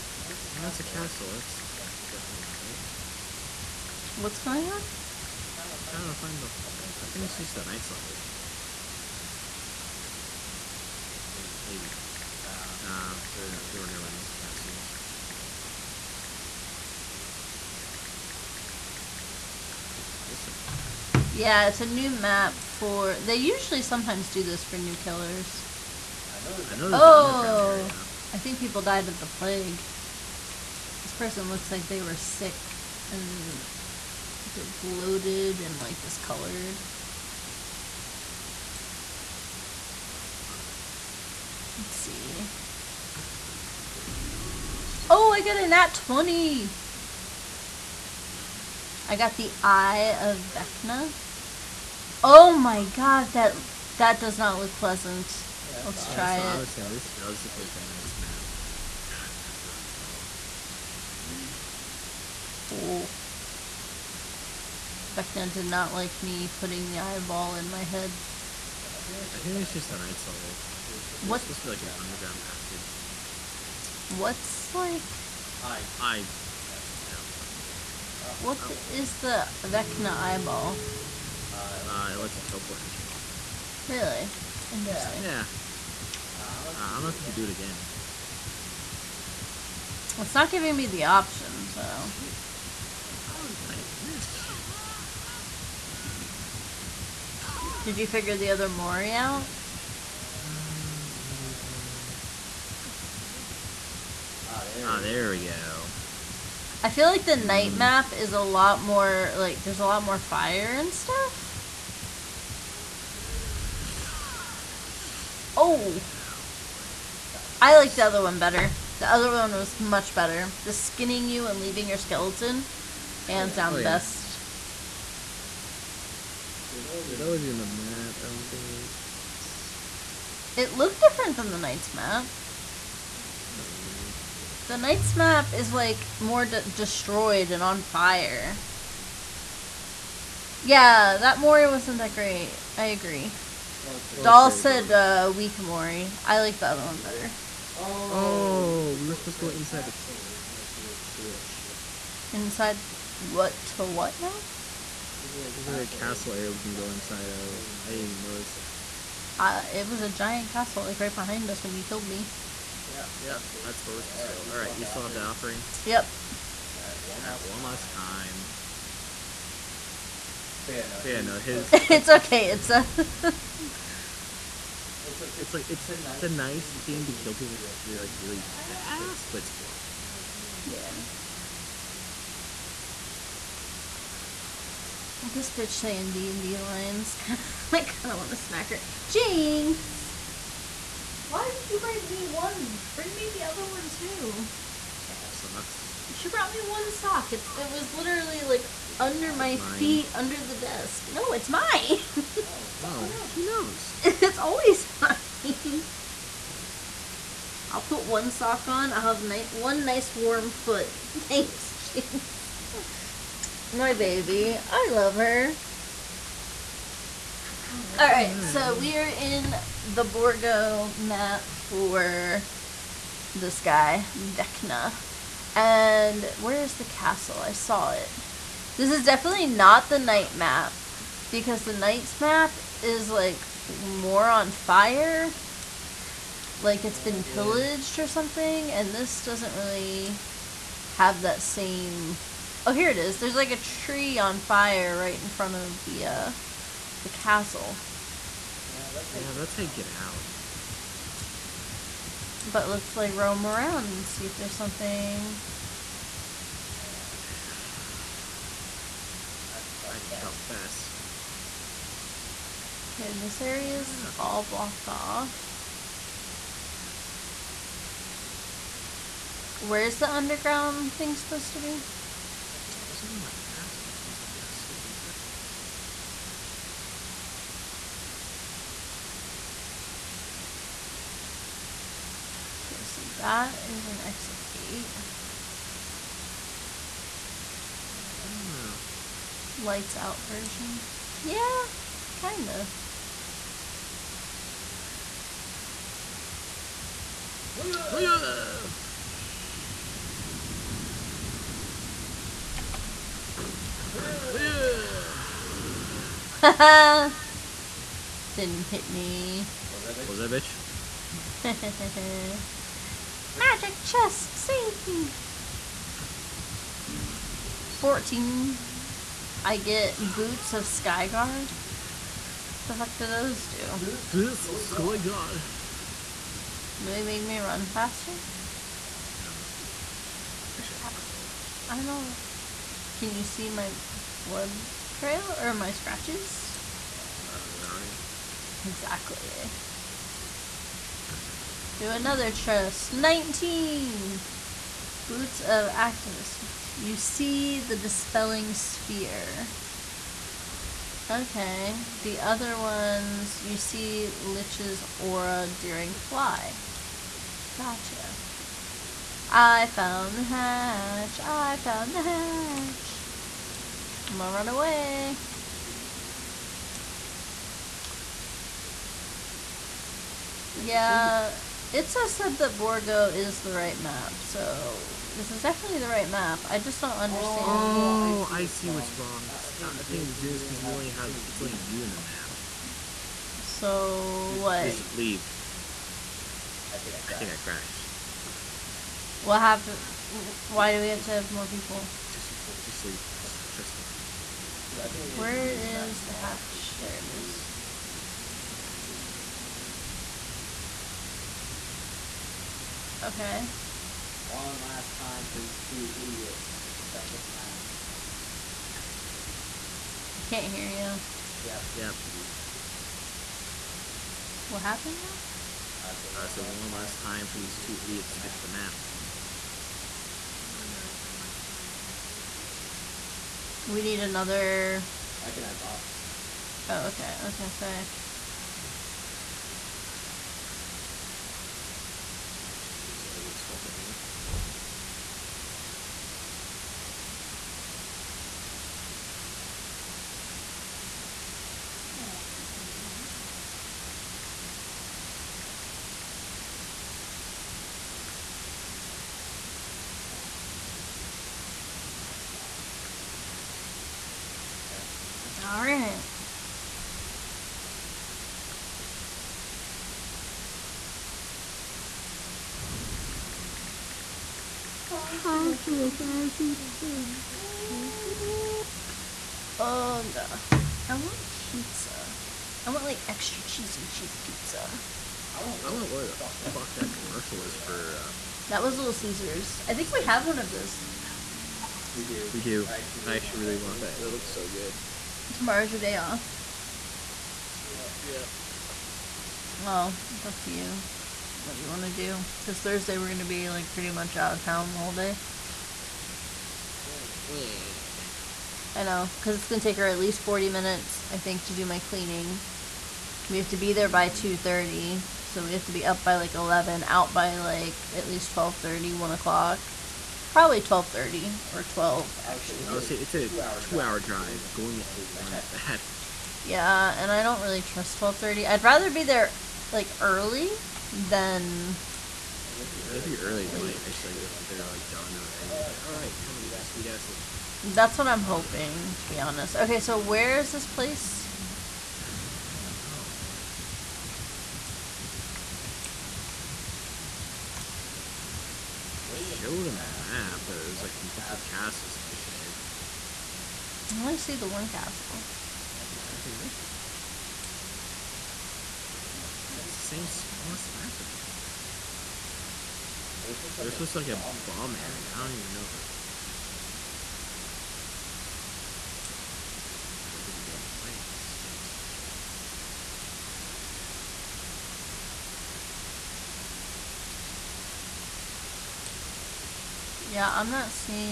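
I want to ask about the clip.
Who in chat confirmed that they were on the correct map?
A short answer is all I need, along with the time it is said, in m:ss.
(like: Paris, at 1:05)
Itza, at 6:11.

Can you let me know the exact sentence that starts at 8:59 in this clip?
Show them there's like multiple castles and shit.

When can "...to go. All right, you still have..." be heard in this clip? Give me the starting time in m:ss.
2:44.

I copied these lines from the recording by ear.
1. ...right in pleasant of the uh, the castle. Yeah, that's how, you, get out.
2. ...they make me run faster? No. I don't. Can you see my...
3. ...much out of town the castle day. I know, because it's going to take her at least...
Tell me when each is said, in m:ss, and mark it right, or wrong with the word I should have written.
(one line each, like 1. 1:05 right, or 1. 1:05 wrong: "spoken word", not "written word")
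1. 4:04 wrong: "front", not "pleasant"
2. 5:26 right
3. 8:13 wrong: "whole", not "castle".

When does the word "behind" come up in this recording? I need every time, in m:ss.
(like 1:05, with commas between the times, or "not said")
2:41.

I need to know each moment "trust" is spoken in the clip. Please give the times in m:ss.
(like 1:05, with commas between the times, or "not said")
6:33, 8:37.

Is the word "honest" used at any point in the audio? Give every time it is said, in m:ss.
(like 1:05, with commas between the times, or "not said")
8:49.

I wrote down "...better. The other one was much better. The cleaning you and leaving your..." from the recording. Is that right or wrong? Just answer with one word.
wrong.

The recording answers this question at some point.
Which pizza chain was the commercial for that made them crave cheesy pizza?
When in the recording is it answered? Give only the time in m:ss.
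7:58.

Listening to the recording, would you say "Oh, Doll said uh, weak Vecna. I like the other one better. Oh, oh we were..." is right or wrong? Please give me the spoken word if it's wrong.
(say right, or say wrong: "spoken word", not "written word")
wrong: "Mori", not "Vecna".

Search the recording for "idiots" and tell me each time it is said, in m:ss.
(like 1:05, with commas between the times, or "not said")
6:46, 6:57.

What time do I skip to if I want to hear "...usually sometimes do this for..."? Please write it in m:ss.
0:23.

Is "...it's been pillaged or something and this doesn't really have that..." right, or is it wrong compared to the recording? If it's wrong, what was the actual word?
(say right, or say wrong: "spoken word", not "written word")
right.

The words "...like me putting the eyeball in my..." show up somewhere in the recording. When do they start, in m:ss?
1:05.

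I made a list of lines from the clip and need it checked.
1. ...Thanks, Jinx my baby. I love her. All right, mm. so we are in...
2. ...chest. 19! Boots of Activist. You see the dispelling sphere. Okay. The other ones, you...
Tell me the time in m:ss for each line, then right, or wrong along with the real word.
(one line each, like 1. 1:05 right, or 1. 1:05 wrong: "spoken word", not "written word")
1. 3:31 right
2. 5:42 right.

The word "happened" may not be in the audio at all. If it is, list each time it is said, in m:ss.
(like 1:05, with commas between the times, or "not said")
6:29, 6:54.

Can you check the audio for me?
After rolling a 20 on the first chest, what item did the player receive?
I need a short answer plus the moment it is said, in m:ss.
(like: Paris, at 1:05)
Eye of Vecna, at 0:49.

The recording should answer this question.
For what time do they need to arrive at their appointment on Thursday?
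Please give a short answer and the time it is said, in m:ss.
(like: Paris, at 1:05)
2:30, at 8:24.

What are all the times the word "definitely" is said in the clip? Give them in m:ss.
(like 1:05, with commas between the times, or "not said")
0:02, 3:49, 6:15.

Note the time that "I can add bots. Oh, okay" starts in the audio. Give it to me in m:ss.
7:05.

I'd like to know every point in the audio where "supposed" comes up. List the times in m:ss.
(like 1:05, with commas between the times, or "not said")
1:11, 2:29, 2:44, 4:31.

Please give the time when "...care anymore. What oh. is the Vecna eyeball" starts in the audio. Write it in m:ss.
1:17.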